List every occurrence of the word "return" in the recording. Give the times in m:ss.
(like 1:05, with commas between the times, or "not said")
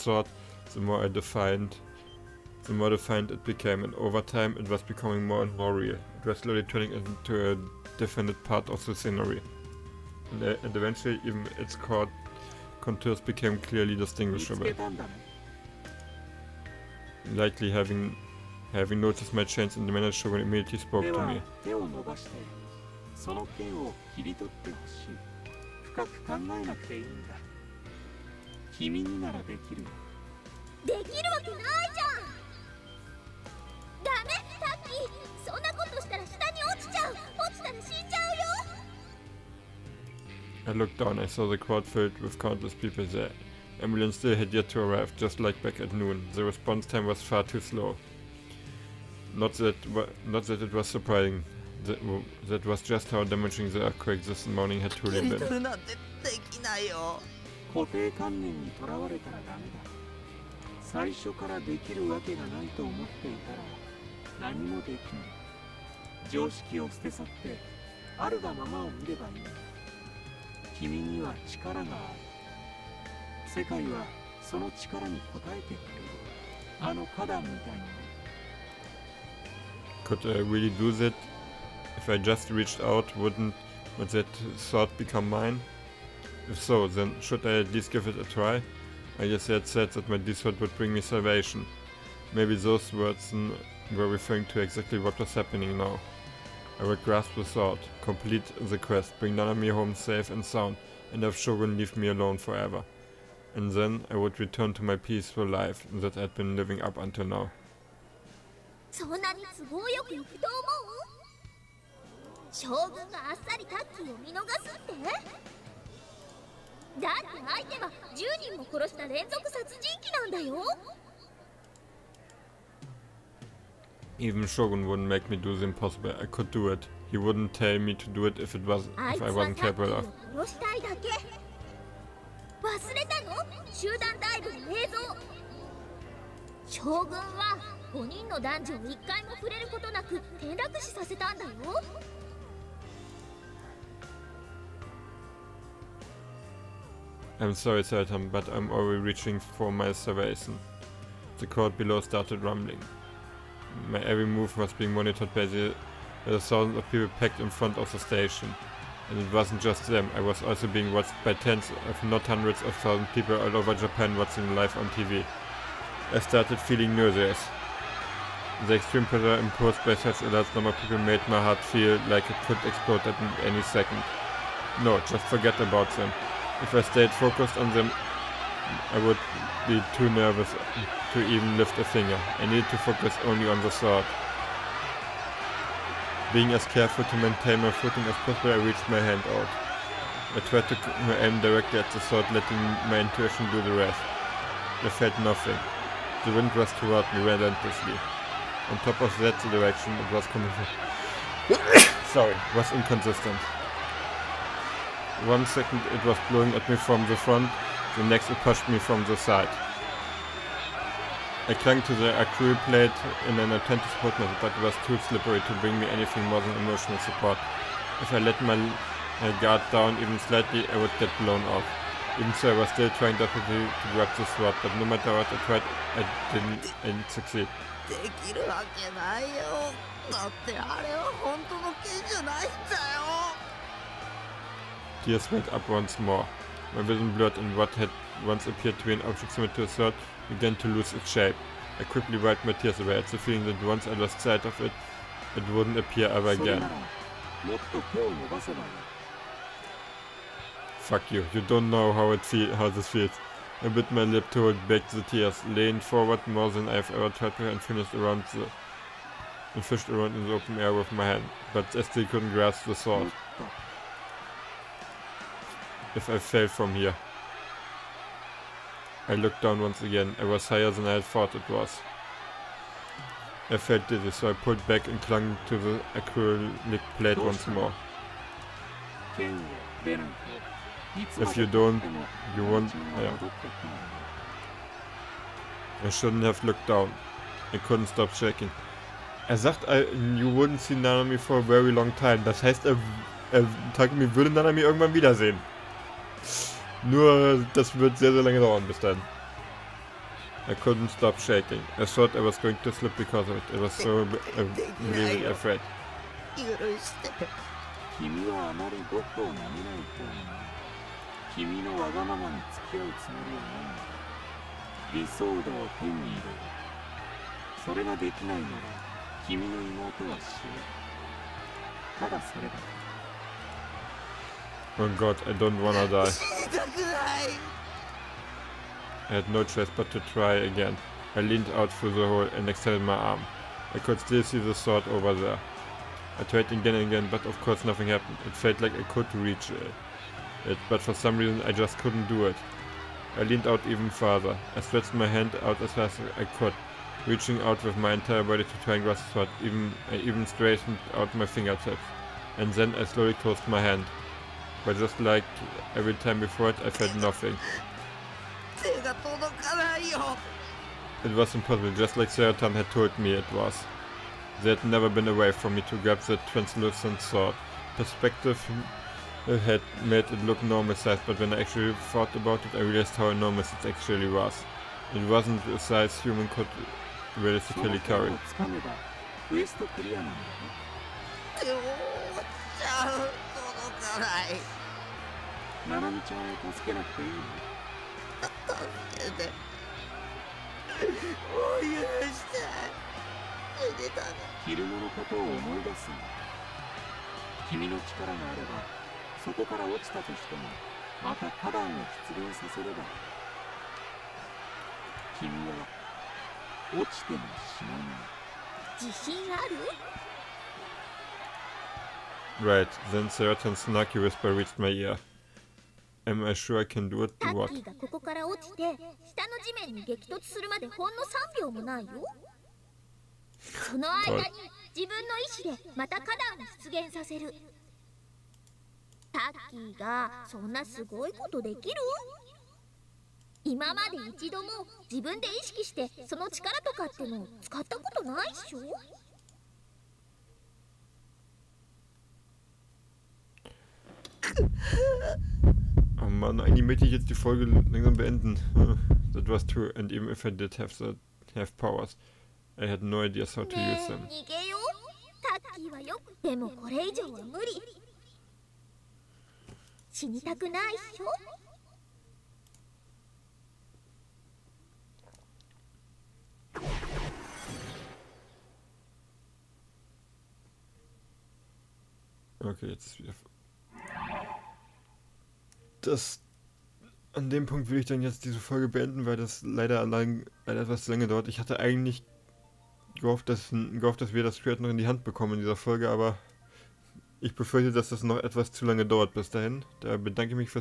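1:44.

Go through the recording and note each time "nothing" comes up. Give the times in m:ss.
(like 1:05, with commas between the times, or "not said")
3:15, 5:37, 5:56.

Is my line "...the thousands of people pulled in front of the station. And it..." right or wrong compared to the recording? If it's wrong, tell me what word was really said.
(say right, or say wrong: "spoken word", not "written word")
wrong: "packed", not "pulled".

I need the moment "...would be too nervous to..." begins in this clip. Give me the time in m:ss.
2:59.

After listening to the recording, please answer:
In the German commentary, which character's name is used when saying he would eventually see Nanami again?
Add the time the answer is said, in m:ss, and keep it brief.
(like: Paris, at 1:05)
Takumi, at 4:53.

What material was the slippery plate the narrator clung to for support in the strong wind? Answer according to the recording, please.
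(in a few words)
Acrylic.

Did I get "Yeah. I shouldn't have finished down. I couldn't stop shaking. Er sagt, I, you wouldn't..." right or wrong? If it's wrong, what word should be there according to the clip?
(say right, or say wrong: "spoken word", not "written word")
wrong: "looked", not "finished".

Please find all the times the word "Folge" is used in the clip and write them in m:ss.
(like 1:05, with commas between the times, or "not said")
7:27, 7:58, 8:05.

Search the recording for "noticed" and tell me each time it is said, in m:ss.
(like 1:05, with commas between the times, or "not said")
0:18.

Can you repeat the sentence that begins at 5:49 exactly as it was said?
Even, I even straightened out my fingertips.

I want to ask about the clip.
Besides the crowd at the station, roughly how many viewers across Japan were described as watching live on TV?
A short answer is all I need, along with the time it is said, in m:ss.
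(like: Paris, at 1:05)
Hundreds of thousands, at 2:42.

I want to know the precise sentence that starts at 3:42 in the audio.
Even so, I was still trying desperately to grab the sword, but no matter what I tried, I didn't, didn't succeed.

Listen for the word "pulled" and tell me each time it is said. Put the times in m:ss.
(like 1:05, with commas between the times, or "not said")
4:34.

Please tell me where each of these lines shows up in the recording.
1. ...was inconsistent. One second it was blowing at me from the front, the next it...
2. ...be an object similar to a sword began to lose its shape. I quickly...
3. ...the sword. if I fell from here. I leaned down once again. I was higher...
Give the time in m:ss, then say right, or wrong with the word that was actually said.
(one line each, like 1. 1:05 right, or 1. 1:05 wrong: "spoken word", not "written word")
1. 3:22 right
2. 3:58 right
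3. 4:22 wrong: "looked", not "leaned".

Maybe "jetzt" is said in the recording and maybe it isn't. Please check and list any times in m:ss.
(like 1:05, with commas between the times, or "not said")
7:26, 7:52, 7:58.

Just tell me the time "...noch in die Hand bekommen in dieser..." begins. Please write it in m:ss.
8:04.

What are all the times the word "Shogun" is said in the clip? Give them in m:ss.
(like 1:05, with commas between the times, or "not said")
1:41, 2:04.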